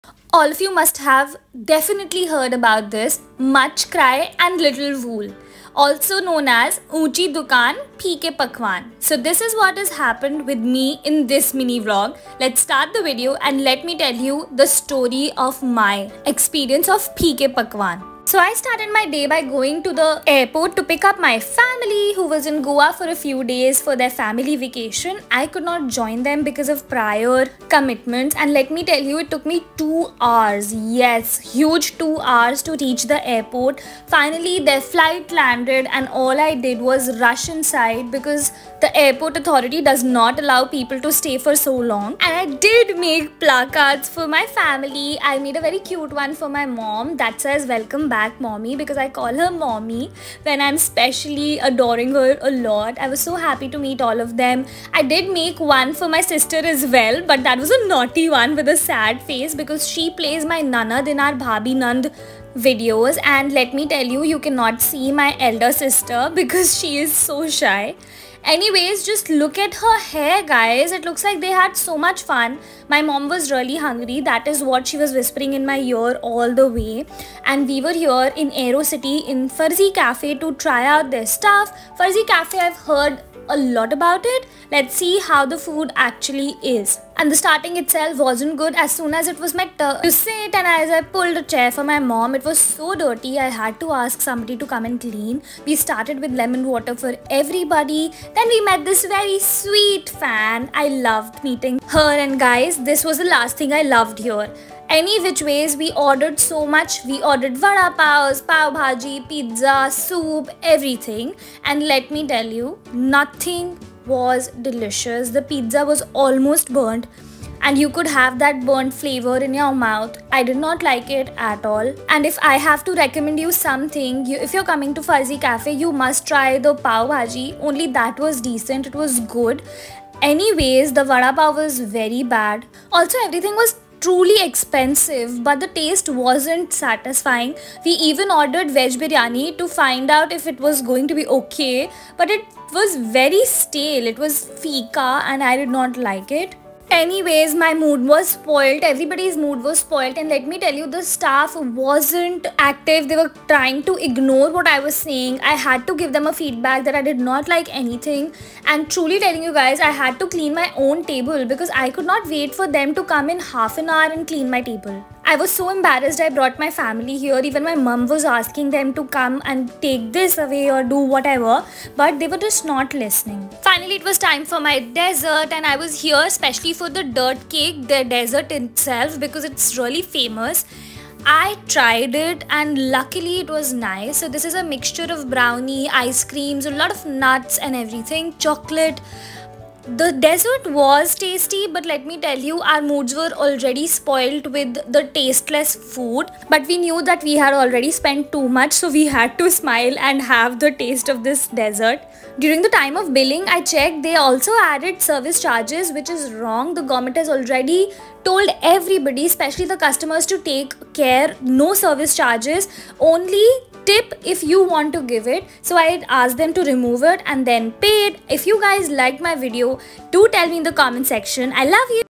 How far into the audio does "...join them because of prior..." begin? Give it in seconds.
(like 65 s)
25 s.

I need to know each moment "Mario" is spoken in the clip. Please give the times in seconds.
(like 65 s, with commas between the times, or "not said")
not said.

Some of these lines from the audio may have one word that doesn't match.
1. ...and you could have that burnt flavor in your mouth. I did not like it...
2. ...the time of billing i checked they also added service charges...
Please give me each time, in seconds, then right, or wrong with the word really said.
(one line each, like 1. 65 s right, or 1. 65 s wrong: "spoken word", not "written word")
1. 117 s right
2. 202 s right.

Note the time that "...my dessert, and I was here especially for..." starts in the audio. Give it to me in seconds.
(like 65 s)
174 s.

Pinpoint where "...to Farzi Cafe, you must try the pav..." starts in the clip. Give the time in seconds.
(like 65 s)
124 s.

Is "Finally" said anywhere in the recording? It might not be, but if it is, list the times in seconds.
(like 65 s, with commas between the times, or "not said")
34 s, 173 s.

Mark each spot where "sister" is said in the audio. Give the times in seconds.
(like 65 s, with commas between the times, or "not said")
56 s, 65 s.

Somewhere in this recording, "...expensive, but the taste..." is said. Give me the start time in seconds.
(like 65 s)
134 s.